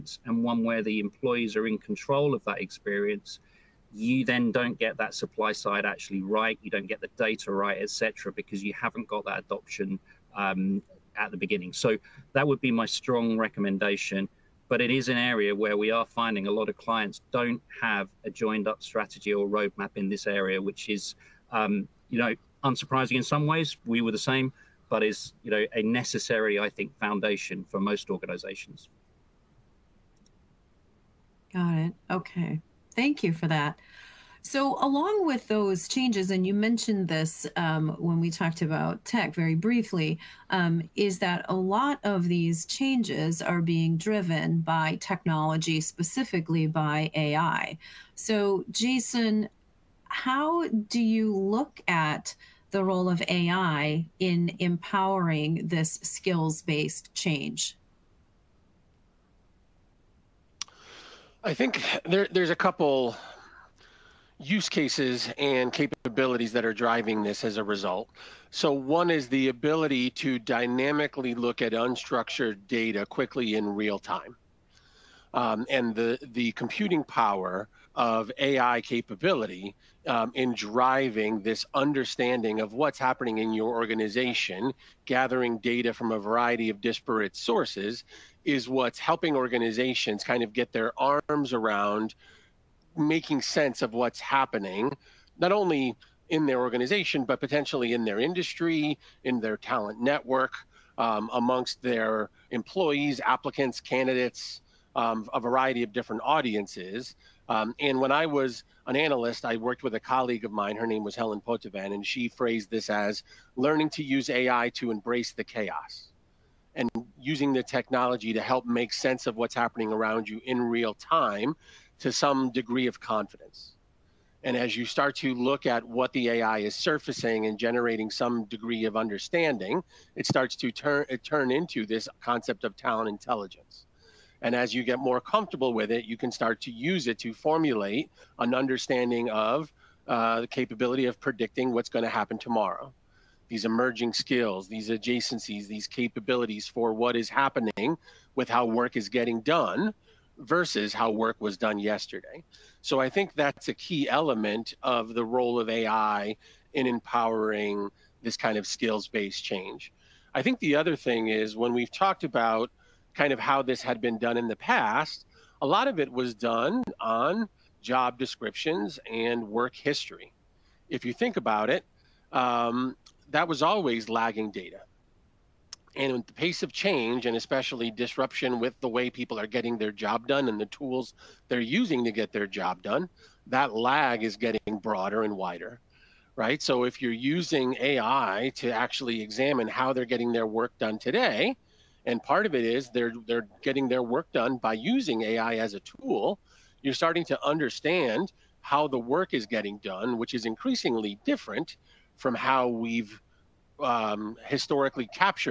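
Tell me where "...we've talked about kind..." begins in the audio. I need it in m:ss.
2:41.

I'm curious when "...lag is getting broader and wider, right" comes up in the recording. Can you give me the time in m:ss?
3:03.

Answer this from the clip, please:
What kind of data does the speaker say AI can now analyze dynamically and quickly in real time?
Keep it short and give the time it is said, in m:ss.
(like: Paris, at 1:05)
unstructured data, at 1:11.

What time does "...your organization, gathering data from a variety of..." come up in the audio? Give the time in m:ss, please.
1:23.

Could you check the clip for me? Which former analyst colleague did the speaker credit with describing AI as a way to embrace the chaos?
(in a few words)
Helen Poitevin.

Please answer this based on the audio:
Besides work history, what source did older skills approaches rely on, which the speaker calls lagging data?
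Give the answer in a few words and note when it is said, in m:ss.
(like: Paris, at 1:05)
job descriptions, at 2:47.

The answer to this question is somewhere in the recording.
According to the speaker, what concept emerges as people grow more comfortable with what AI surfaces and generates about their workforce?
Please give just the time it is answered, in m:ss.
2:12.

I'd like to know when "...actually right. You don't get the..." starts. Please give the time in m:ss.
0:05.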